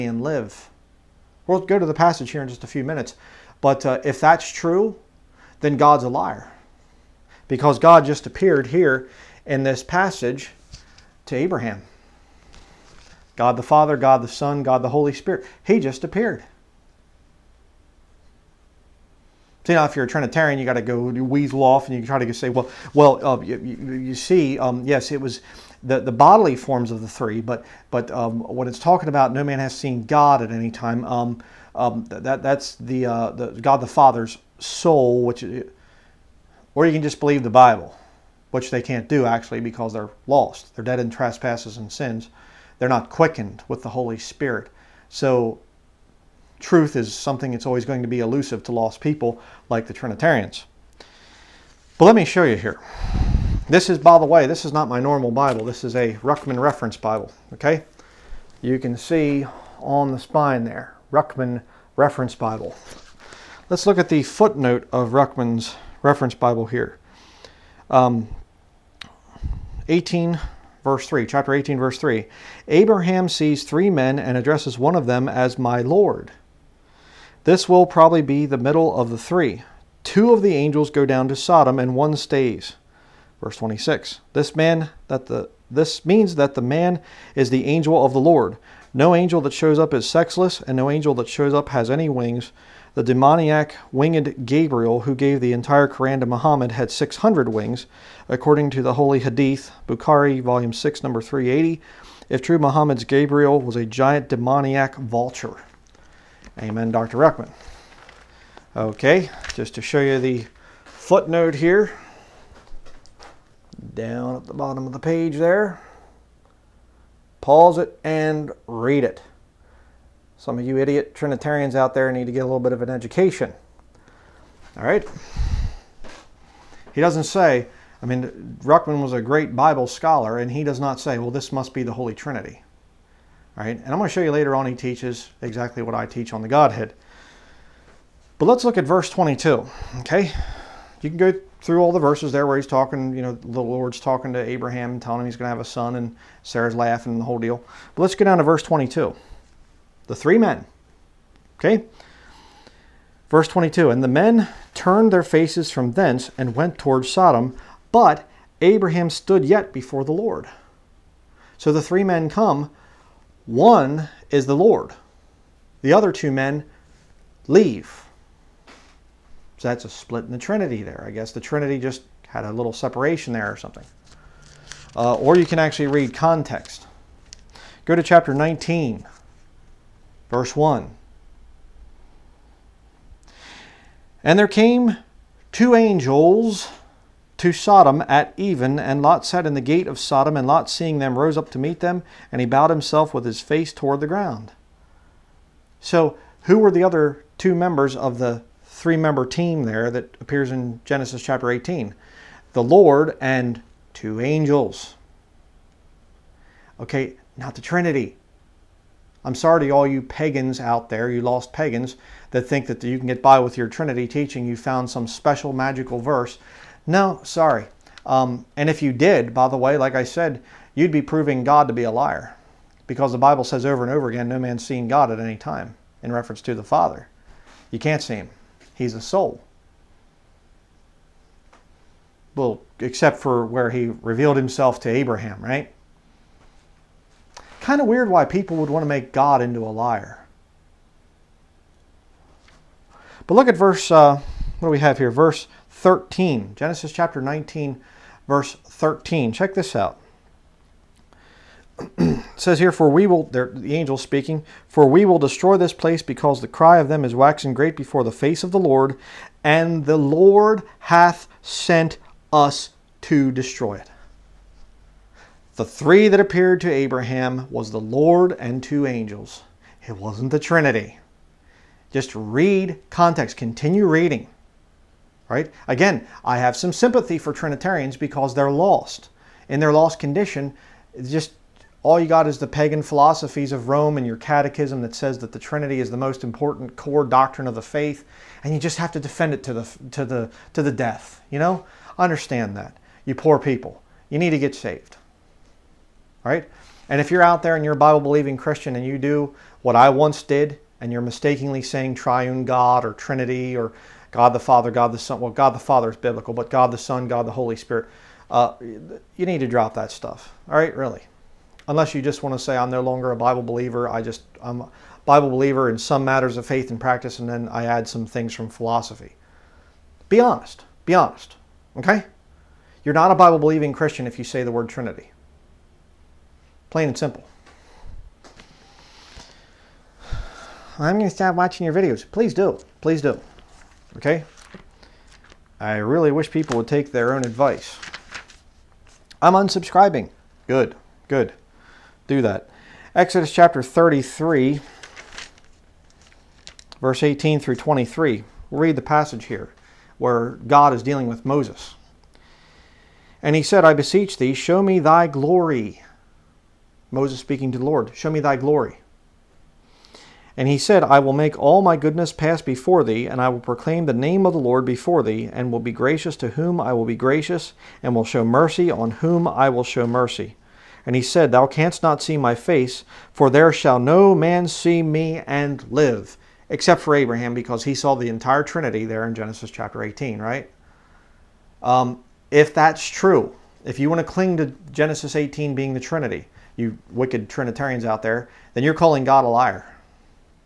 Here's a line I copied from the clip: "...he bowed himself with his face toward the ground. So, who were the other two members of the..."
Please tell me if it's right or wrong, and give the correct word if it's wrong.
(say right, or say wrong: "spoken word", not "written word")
right.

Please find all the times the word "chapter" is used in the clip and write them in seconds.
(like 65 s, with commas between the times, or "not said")
71 s, 178 s, 201 s, 246 s, 343 s, 379 s.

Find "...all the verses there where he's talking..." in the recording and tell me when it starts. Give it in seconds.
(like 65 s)
141 s.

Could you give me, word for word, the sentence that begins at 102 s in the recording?
If true, Muhammad's Gabriel was a giant demoniac vulture.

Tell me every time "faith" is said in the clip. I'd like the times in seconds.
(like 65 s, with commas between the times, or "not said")
287 s, 316 s.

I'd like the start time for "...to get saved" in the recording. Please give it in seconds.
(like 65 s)
294 s.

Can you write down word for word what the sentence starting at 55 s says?
This is a Ruckman Reference Bible, okay?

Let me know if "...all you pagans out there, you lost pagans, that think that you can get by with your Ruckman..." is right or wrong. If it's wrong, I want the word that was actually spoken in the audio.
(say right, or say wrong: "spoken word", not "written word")
wrong: "Trinity", not "Ruckman".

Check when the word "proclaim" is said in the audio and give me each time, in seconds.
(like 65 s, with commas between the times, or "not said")
363 s.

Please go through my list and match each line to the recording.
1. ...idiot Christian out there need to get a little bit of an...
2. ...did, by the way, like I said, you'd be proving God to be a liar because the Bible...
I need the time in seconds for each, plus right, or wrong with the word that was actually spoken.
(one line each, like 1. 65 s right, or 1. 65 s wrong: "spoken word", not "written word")
1. 120 s wrong: "Trinitarians", not "Christian"
2. 218 s right.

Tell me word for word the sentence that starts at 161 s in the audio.
So the three men come, one is the Lord.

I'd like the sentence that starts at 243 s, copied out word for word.
But look at verse, uh, what do we have here?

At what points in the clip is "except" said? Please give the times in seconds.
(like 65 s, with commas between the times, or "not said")
232 s, 376 s.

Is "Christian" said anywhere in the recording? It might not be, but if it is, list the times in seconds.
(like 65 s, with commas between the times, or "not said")
298 s, 323 s.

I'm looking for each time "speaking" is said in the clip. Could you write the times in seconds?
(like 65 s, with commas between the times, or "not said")
253 s, 357 s.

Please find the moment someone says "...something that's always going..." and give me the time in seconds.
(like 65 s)
47 s.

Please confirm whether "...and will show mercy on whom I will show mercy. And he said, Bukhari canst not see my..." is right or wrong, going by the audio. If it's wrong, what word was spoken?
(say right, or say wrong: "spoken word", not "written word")
wrong: "Thou", not "Bukhari".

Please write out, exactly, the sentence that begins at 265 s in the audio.
The three that appeared to Abraham was the Lord and two angels.